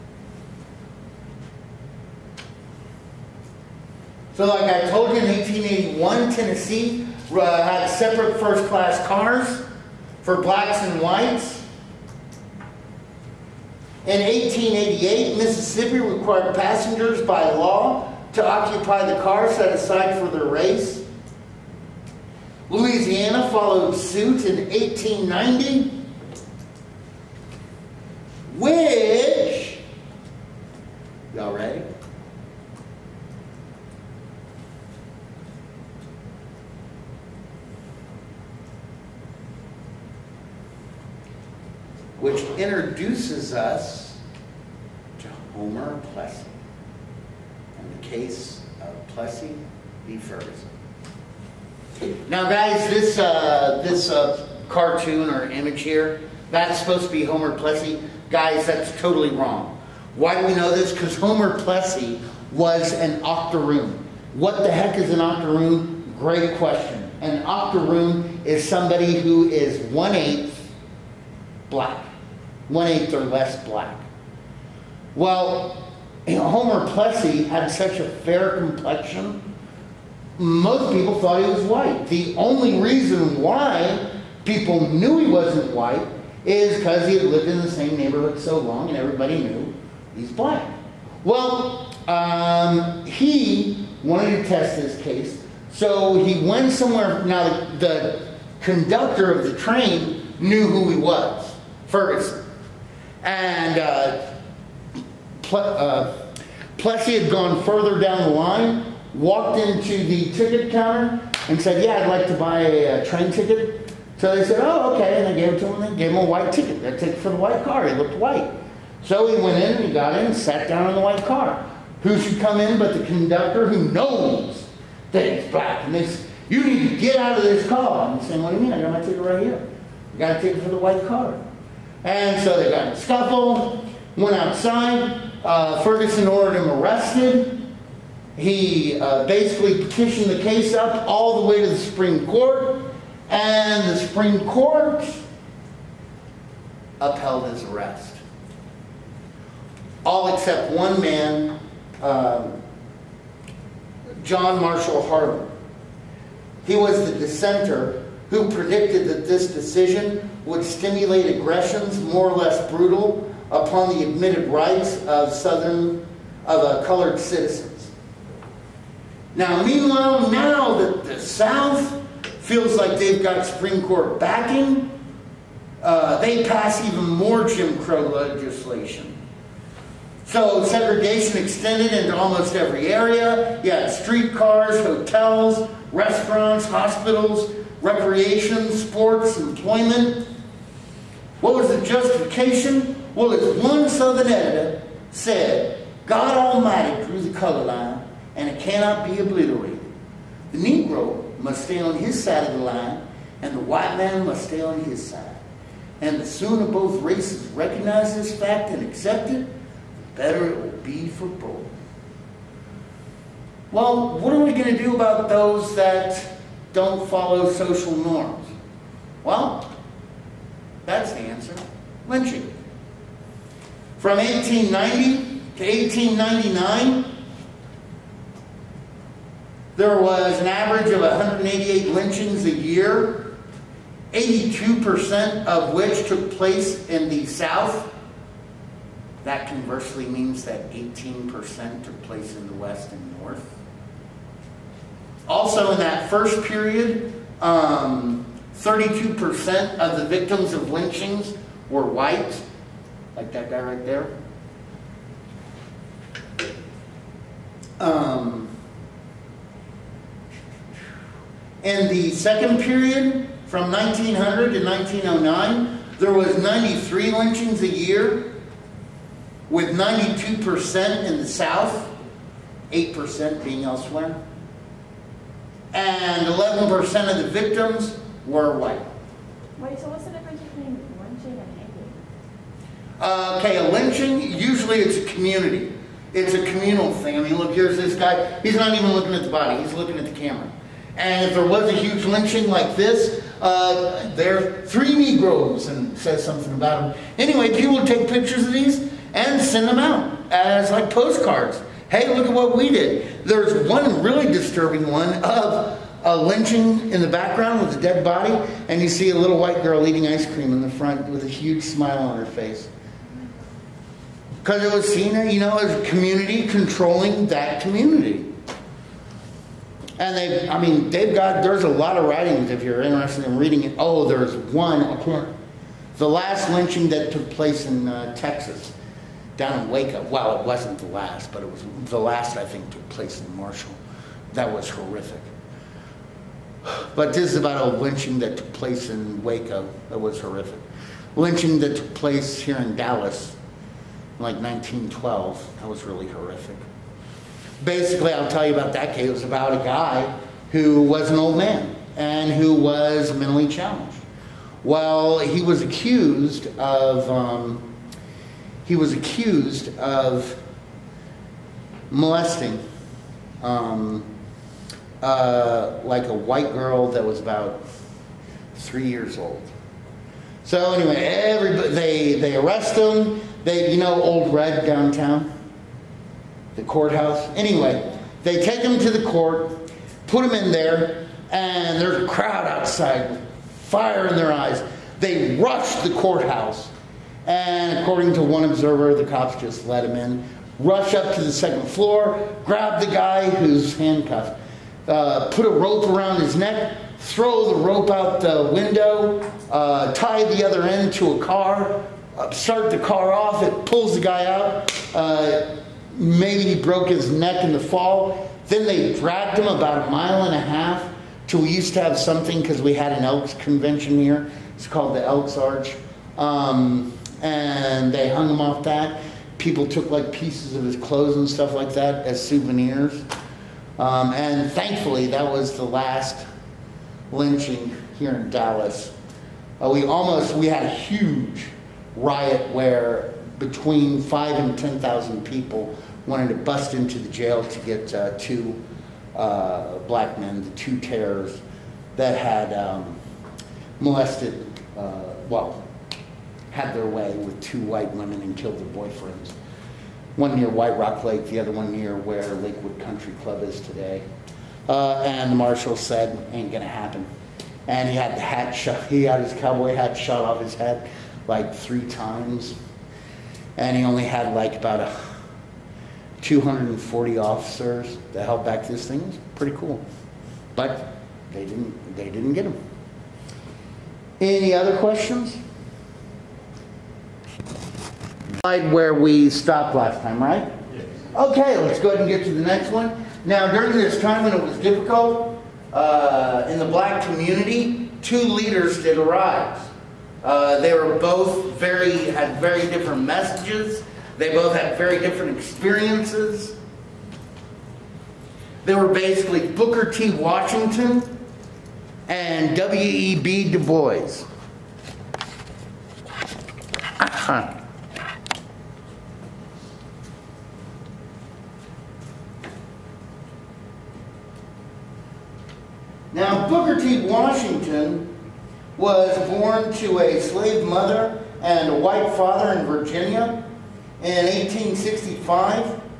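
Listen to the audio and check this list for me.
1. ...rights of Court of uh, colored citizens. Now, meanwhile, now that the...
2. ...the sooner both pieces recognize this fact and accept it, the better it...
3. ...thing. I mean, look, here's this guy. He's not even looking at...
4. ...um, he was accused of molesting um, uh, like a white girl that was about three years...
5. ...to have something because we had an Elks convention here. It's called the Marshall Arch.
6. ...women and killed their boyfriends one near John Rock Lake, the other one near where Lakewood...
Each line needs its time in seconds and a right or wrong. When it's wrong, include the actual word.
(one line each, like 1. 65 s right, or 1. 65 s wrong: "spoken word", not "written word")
1. 164 s wrong: "Southern", not "Court"
2. 206 s wrong: "races", not "pieces"
3. 286 s right
4. 357 s right
5. 411 s wrong: "Elks", not "Marshall"
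6. 447 s wrong: "White", not "John".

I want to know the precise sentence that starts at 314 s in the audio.
Because it was seen, you know, as a community controlling that community.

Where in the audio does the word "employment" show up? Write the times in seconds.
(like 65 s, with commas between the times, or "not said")
189 s.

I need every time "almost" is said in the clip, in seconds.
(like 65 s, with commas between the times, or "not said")
182 s, 429 s.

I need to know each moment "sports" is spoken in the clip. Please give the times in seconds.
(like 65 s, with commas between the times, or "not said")
188 s.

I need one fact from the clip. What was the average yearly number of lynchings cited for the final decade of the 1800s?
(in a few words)
188.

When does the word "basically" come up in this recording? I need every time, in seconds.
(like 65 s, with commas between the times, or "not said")
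139 s, 347 s, 498 s.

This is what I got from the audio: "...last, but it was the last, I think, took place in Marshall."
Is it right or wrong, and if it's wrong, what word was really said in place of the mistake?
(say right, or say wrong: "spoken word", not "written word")
right.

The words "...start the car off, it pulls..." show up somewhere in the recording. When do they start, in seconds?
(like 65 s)
402 s.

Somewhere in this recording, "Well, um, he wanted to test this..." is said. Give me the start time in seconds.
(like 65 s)
91 s.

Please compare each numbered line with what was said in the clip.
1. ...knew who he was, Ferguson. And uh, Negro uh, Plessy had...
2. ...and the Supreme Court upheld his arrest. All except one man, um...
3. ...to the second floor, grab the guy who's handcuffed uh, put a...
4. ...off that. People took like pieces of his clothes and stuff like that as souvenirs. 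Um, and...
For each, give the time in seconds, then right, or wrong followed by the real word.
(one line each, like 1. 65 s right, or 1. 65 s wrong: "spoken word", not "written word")
1. 100 s wrong: "Ple", not "Negro"
2. 143 s right
3. 391 s right
4. 418 s right.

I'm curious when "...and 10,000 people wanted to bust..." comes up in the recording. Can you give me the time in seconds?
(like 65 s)
434 s.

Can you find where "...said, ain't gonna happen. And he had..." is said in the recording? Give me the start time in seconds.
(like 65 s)
455 s.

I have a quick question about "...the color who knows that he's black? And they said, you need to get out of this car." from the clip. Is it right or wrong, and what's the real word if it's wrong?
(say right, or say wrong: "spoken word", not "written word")
wrong: "conductor", not "color".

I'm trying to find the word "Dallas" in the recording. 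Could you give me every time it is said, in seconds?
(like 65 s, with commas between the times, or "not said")
342 s, 428 s.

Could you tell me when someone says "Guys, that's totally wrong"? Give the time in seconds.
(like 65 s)
58 s.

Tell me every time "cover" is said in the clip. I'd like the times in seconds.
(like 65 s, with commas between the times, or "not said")
not said.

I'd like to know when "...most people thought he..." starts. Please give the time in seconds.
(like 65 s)
80 s.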